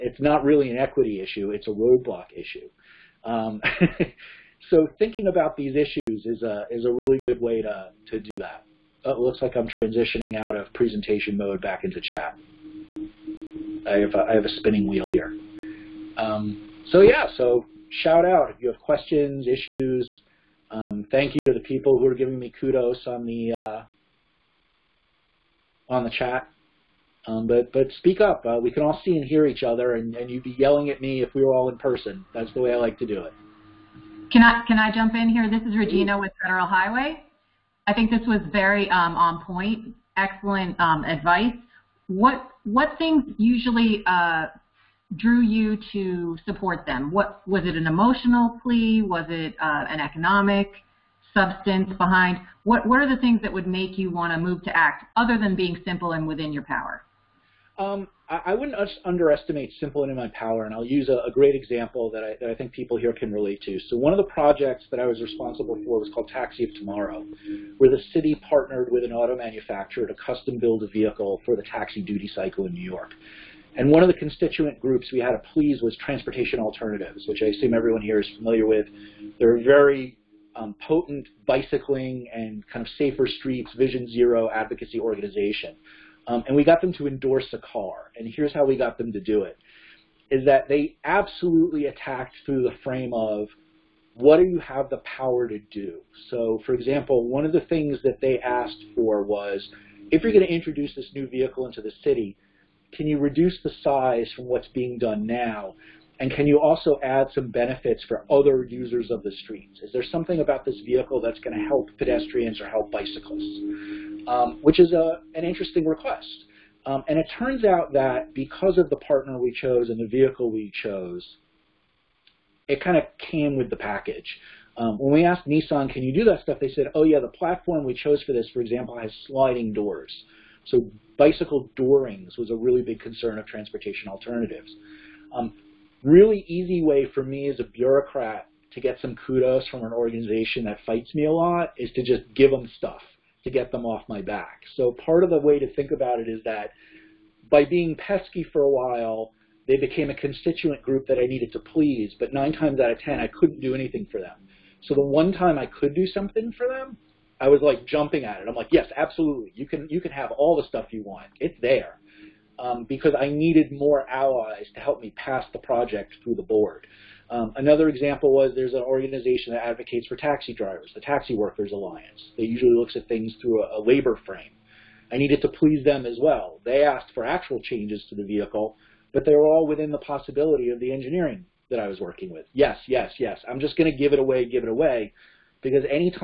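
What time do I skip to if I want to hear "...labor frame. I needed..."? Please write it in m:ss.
2:53.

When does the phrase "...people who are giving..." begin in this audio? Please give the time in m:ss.
0:21.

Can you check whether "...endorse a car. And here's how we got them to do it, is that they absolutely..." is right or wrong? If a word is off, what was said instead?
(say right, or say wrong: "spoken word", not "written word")
right.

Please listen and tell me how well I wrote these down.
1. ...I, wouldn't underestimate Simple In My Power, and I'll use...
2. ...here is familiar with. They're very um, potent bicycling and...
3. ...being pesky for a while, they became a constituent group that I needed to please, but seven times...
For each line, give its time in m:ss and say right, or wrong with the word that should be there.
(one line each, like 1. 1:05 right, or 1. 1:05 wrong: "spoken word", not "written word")
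1. 0:58 right
2. 1:18 right
3. 2:27 wrong: "nine", not "seven".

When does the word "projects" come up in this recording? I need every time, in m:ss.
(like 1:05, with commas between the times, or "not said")
1:04, 2:45.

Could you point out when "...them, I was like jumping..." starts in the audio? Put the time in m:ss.
2:36.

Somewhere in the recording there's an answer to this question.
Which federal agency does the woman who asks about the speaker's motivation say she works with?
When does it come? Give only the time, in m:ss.
0:36.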